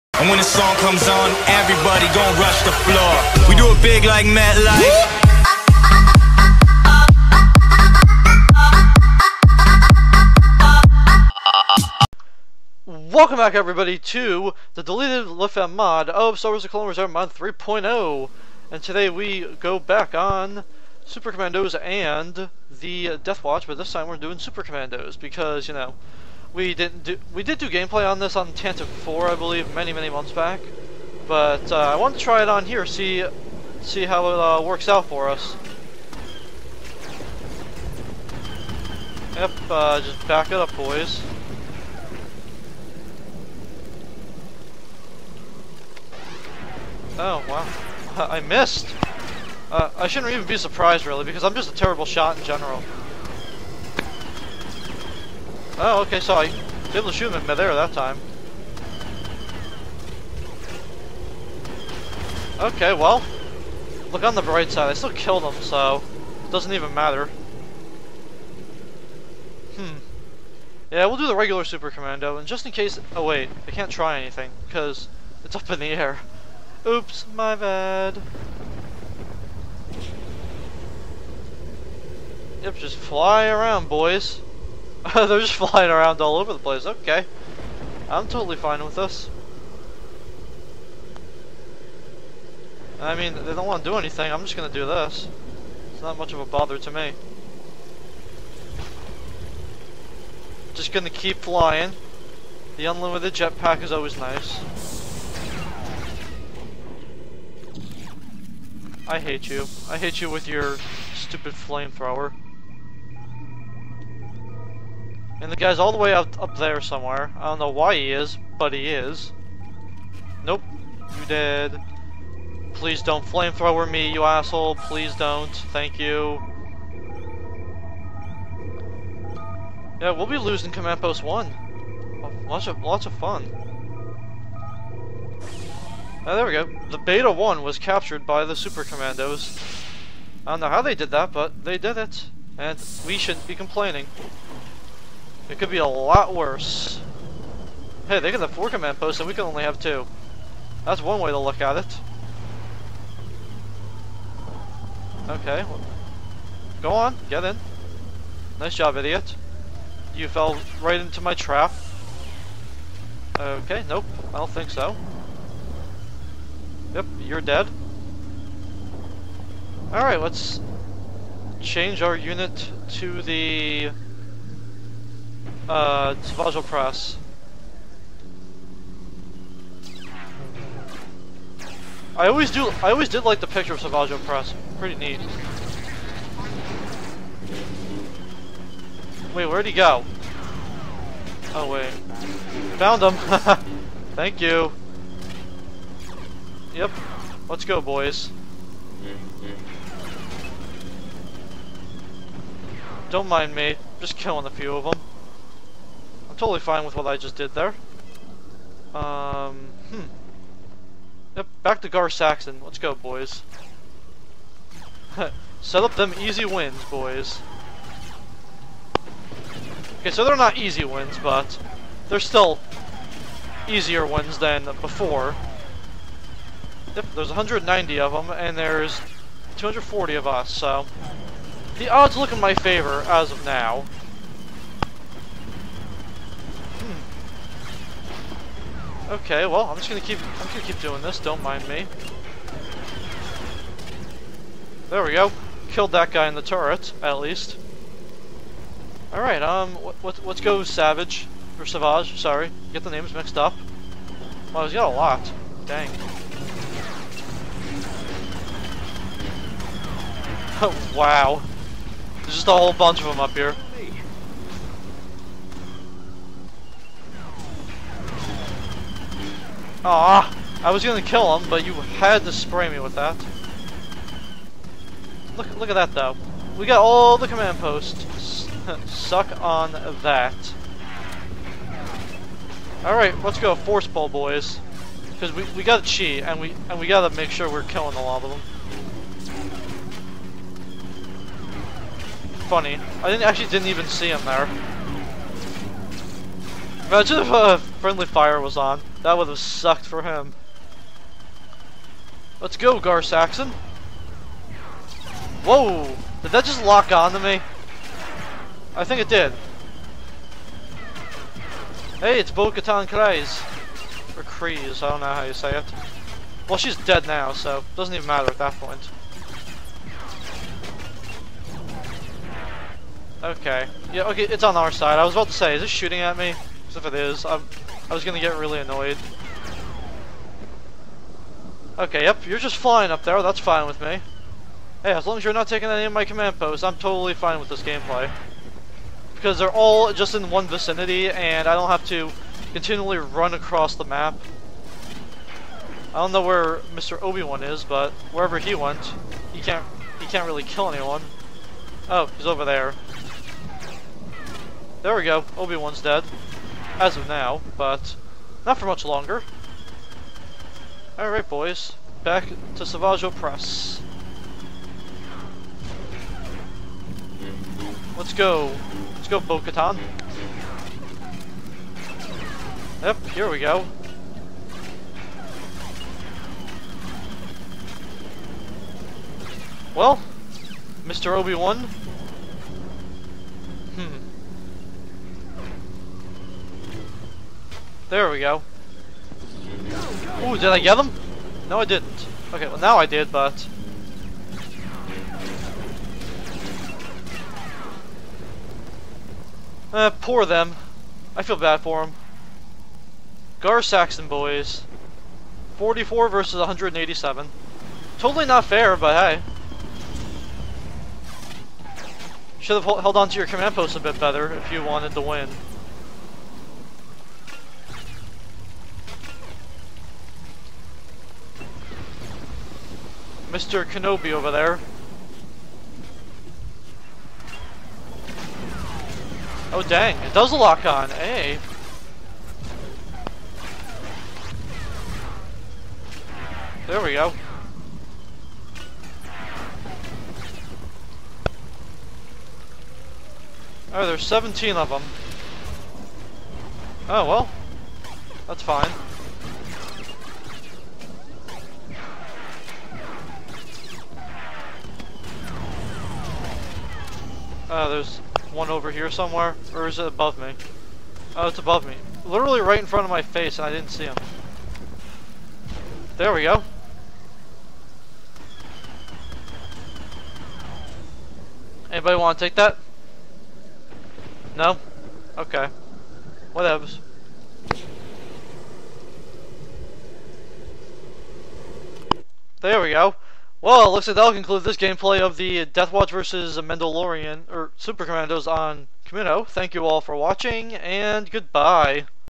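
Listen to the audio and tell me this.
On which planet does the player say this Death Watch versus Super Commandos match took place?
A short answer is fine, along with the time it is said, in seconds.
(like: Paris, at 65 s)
Kamino, at 488 s.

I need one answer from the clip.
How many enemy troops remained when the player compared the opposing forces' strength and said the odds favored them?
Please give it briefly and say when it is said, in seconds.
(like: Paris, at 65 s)
190, at 227 s.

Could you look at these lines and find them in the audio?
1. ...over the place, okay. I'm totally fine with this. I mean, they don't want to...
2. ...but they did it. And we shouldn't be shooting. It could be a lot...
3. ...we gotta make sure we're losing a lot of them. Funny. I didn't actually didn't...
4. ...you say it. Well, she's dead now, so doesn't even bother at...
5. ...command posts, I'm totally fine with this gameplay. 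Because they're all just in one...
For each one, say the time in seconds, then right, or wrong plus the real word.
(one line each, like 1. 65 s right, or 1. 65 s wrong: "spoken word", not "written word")
1. 86 s right
2. 141 s wrong: "complaining", not "shooting"
3. 286 s wrong: "killing", not "losing"
4. 315 s wrong: "matter", not "bother"
5. 336 s right.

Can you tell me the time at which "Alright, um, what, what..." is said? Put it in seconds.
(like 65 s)
249 s.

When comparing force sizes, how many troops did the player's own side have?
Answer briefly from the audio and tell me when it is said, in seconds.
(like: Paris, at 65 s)
240, at 229 s.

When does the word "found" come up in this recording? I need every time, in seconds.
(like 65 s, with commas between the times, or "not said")
192 s.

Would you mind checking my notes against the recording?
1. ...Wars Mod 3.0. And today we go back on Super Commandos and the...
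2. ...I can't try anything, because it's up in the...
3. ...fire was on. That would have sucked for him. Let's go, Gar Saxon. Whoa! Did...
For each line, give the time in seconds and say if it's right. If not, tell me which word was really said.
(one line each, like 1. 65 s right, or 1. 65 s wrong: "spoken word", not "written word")
1. 16 s right
2. 73 s right
3. 298 s right.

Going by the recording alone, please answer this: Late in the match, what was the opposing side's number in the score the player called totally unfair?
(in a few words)
44.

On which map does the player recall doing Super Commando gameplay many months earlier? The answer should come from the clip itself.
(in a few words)
Tantive 4.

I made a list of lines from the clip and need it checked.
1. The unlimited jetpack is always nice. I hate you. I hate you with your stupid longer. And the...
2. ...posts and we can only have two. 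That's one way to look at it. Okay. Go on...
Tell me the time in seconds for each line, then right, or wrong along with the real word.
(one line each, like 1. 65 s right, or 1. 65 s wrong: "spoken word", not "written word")
1. 102 s wrong: "flamethrower", not "longer"
2. 149 s right.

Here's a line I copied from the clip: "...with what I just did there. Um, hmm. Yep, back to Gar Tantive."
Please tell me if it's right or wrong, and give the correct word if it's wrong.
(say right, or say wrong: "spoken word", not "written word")
wrong: "Saxon", not "Tantive".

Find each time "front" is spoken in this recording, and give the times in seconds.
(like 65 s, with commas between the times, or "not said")
462 s.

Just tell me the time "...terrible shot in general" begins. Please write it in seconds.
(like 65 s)
51 s.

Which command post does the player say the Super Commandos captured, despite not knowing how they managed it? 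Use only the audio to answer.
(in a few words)
Beta 1.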